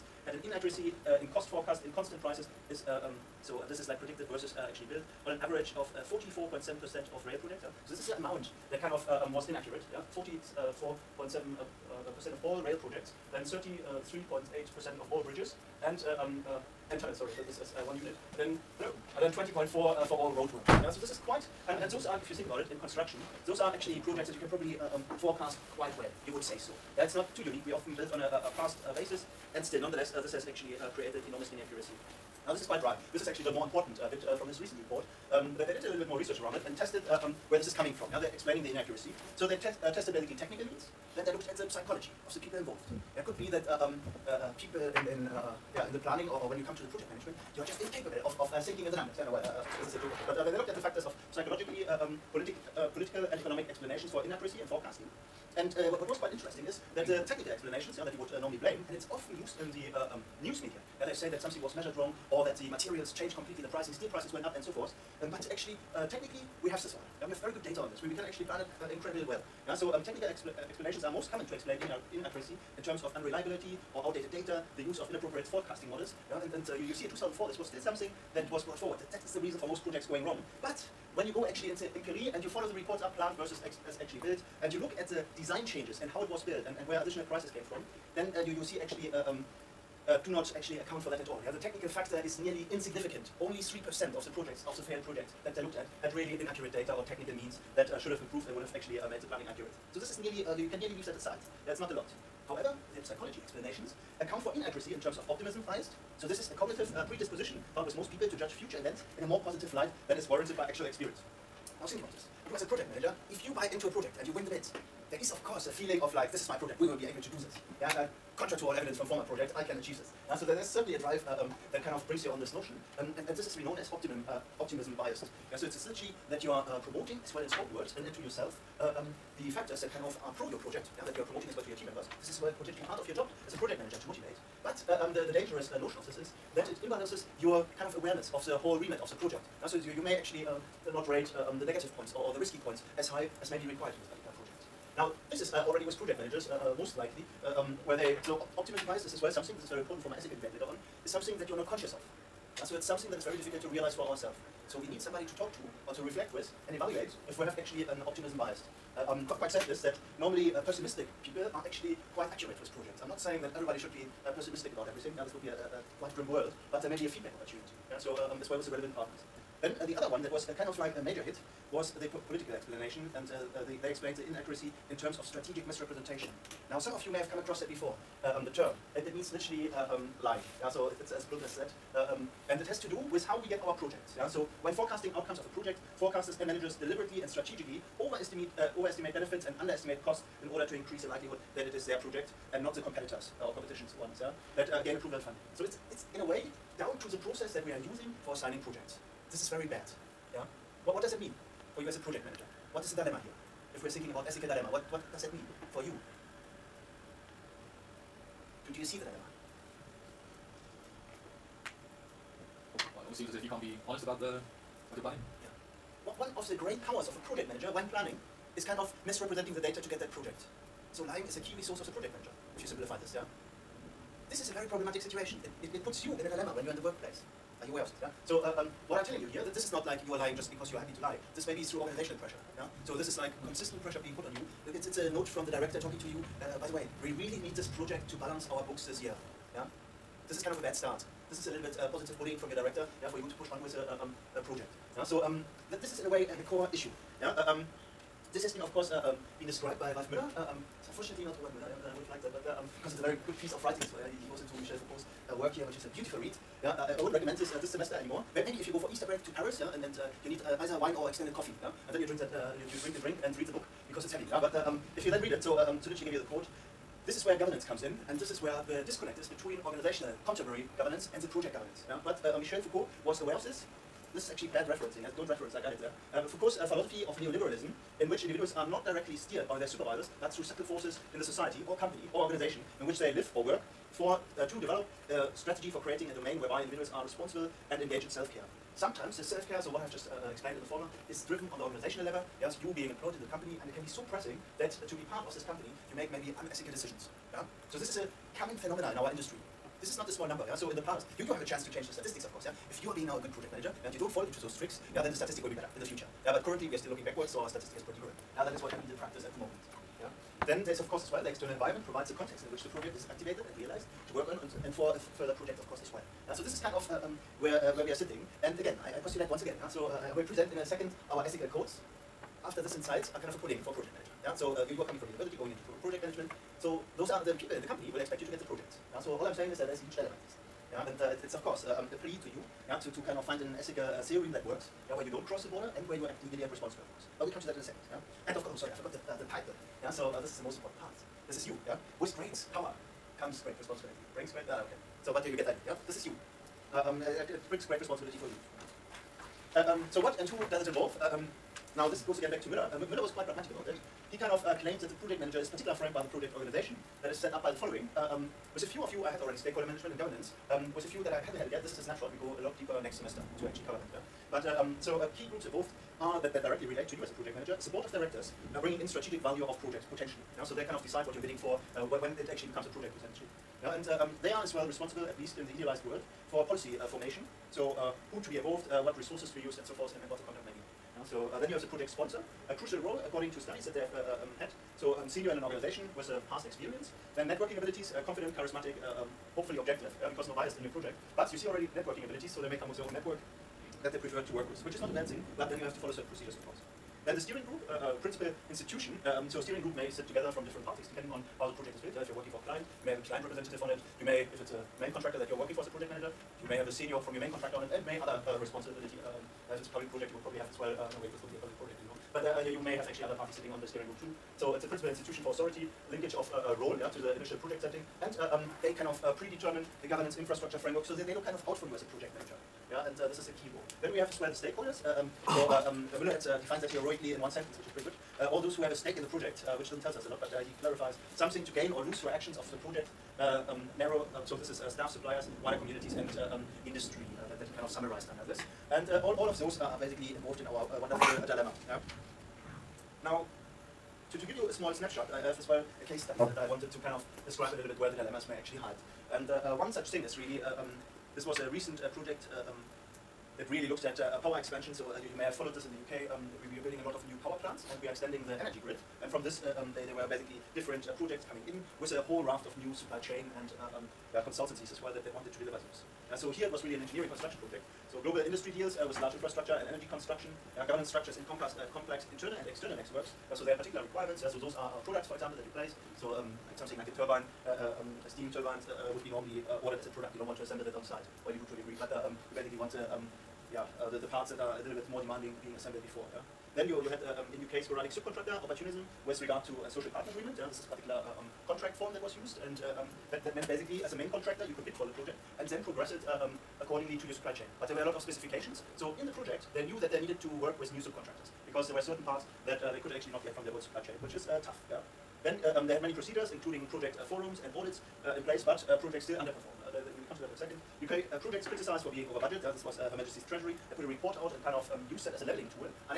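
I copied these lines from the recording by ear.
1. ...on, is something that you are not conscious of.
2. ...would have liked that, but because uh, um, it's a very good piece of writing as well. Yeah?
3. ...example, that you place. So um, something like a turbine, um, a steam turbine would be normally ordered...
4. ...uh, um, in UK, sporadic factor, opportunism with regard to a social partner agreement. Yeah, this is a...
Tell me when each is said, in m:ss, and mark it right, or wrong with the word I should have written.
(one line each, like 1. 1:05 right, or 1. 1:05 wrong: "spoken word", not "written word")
1. 2:30 right
2. 4:11 right
3. 7:55 right
4. 8:07 wrong: "subcontractor", not "factor".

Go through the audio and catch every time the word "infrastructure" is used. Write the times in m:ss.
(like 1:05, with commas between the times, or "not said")
7:00, 7:49.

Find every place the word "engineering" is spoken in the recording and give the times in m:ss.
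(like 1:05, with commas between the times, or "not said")
7:46.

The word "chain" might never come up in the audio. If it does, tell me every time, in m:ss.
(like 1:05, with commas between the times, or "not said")
7:43, 8:17, 8:23.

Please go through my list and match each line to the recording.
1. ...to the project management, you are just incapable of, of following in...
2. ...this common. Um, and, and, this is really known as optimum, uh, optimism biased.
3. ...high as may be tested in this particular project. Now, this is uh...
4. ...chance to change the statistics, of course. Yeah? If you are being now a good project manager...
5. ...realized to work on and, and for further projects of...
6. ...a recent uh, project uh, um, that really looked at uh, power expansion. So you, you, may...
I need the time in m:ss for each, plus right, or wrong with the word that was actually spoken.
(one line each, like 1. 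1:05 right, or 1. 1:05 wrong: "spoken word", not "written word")
1. 0:46 wrong: "thinking", not "following"
2. 2:02 wrong: "notion", not "common"
3. 2:23 wrong: "required", not "tested"
4. 5:01 right
5. 5:13 right
6. 7:31 right.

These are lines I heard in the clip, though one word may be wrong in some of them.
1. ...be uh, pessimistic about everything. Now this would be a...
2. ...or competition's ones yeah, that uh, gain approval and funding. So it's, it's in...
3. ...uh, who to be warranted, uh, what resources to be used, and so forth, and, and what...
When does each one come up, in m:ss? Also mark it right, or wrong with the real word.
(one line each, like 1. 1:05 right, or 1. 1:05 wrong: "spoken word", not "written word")
1. 2:43 right
2. 3:13 right
3. 6:17 wrong: "involved", not "warranted".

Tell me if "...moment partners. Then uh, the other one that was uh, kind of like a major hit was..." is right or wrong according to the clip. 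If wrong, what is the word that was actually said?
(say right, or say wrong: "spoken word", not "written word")
wrong: "relevant", not "moment".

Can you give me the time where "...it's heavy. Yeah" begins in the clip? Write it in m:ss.
4:24.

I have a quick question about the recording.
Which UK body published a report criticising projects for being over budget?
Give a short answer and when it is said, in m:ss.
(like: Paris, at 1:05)
Her Majesty's Treasury, at 8:32.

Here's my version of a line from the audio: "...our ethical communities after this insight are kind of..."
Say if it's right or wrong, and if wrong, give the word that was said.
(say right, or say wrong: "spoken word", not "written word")
wrong: "codes", not "communities".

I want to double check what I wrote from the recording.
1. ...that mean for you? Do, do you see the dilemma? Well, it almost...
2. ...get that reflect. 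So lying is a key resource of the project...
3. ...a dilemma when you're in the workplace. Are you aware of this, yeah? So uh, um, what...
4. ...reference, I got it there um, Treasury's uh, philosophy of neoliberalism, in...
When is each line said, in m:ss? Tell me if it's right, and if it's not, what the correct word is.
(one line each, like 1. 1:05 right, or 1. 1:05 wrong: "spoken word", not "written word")
1. 3:25 right
2. 3:39 wrong: "project", not "reflect"
3. 3:46 right
4. 4:35 wrong: "Foucault", not "Treasury".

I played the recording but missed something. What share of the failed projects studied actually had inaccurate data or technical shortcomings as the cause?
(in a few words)
3%.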